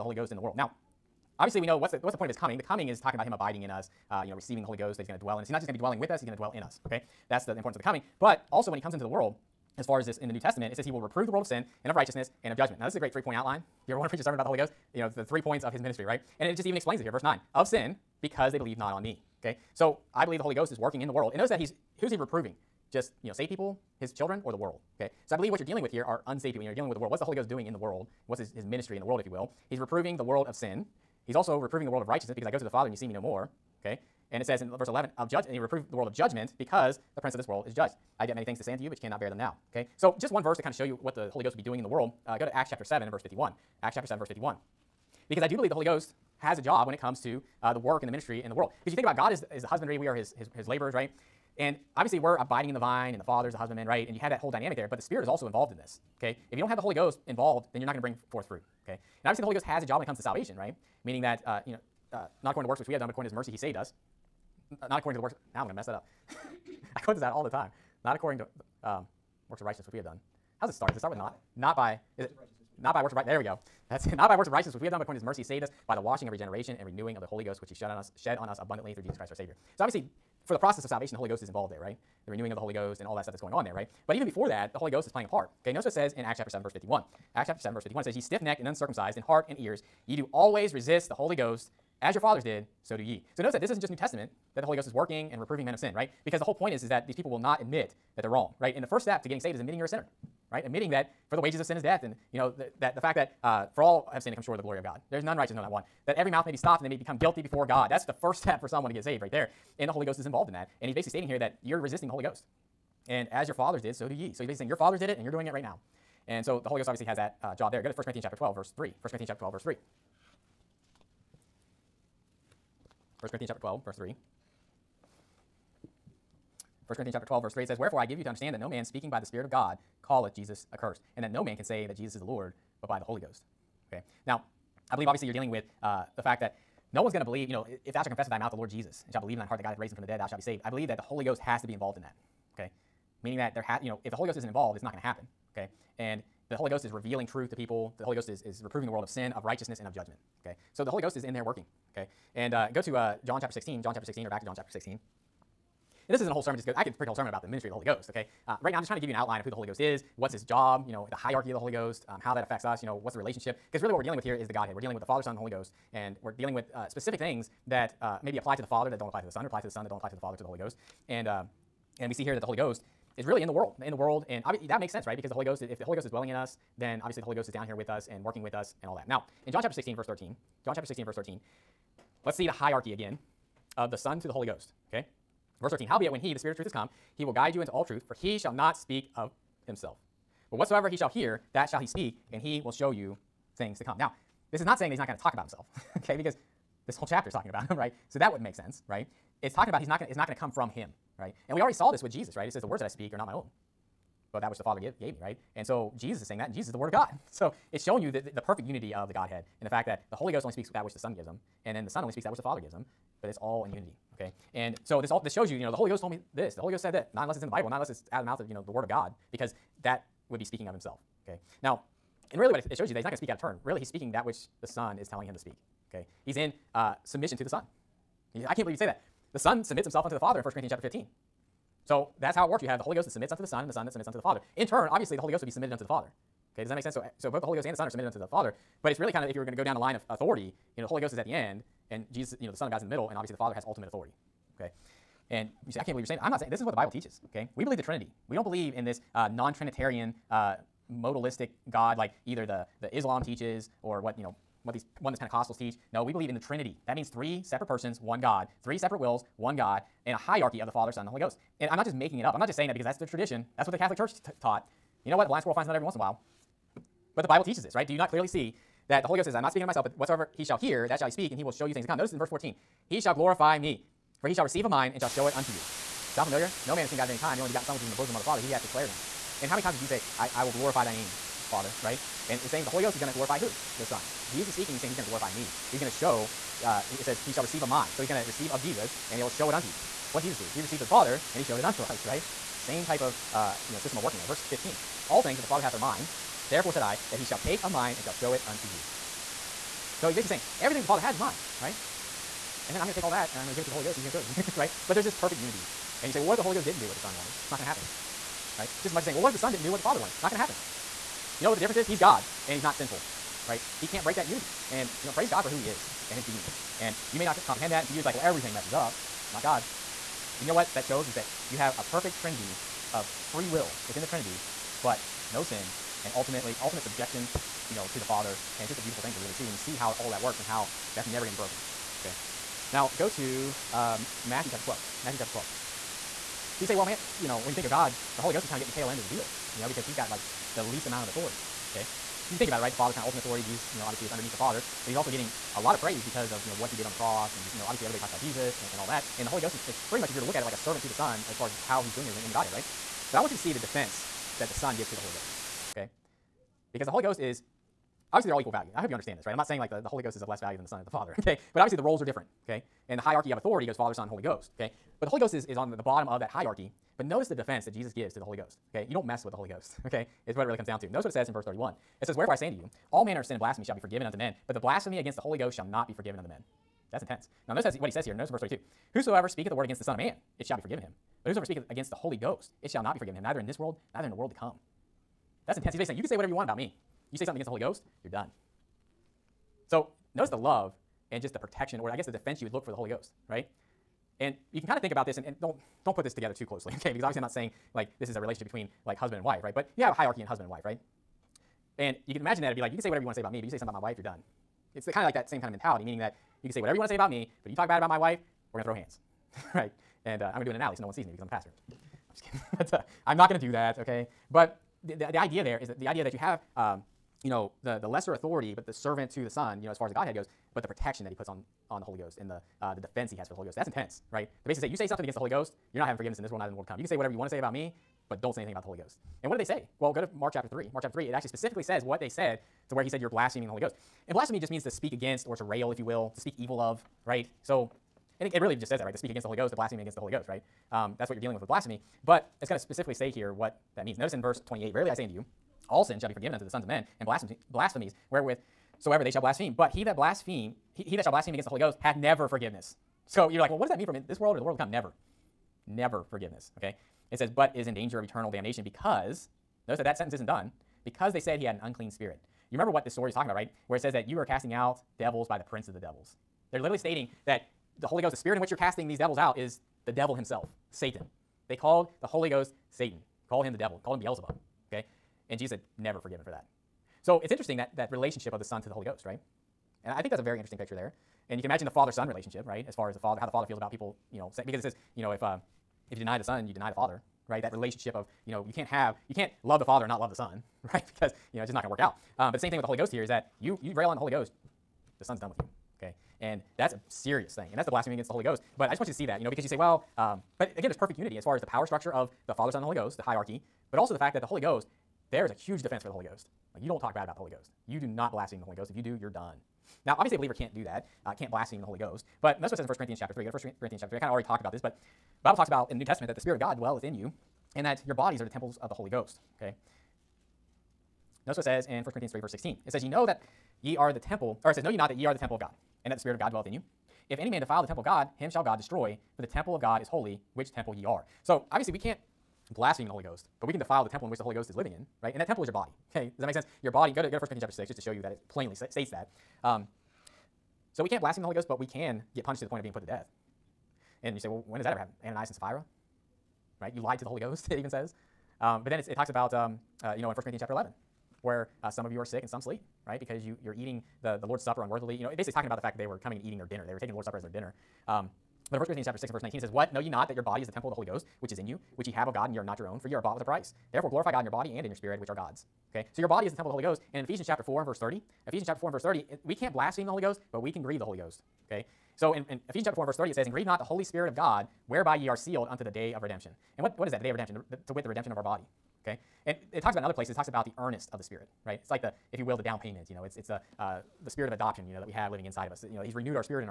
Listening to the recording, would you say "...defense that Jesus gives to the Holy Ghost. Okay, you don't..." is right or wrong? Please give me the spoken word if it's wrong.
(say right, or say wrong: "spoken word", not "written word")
right.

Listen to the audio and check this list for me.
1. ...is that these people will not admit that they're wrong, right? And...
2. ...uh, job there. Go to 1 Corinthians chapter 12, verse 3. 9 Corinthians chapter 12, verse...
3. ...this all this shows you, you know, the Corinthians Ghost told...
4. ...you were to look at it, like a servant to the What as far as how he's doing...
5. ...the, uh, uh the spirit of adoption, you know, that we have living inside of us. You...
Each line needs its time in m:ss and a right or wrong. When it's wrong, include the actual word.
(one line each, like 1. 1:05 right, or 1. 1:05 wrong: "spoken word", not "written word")
1. 1:36 right
2. 1:57 wrong: "1", not "9"
3. 3:35 wrong: "Holy", not "Corinthians"
4. 5:50 wrong: "Son", not "What"
5. 9:43 right.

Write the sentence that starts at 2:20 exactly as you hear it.
I believe that the Holy Ghost has to be involved in that.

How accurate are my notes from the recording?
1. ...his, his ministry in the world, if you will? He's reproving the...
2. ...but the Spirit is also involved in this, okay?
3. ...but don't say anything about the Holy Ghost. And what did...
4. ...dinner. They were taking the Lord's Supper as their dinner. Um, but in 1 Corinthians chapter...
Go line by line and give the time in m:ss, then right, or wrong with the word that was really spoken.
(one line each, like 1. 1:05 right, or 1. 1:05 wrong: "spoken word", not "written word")
1. 0:28 right
2. 0:54 right
3. 7:08 right
4. 9:16 right.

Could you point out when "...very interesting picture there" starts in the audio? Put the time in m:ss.
8:00.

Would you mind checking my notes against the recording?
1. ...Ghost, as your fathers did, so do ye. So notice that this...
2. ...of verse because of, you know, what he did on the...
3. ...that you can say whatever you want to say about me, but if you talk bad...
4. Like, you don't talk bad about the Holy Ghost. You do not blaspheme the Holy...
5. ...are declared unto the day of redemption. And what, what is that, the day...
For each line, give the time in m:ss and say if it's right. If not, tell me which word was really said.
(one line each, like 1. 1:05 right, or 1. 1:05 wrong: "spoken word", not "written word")
1. 1:31 right
2. 5:45 wrong: "praise", not "verse"
3. 6:45 right
4. 8:26 right
5. 9:35 wrong: "sealed", not "declared".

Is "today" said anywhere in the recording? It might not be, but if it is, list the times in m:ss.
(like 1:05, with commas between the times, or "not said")
not said.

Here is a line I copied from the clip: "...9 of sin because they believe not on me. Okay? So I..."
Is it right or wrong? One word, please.
right.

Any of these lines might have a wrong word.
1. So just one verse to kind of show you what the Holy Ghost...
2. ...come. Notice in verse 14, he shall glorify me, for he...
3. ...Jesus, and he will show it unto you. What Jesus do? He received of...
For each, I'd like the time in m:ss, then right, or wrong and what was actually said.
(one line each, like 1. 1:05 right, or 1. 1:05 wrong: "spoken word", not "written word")
1. 0:39 right
2. 4:31 right
3. 4:48 right.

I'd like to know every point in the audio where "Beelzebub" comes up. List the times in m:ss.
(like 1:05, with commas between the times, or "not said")
7:53.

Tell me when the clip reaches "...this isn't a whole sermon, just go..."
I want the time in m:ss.
2:36.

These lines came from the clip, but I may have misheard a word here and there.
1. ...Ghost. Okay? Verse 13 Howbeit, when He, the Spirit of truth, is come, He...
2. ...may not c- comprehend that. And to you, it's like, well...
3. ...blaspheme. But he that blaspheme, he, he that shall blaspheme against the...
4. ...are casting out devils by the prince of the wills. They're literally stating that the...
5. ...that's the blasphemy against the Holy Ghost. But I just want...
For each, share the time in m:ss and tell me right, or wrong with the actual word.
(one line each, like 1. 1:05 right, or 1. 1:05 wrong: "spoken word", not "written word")
1. 3:04 right
2. 5:17 right
3. 7:29 right
4. 7:44 wrong: "devils", not "wills"
5. 8:17 right.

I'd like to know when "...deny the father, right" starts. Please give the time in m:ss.
8:06.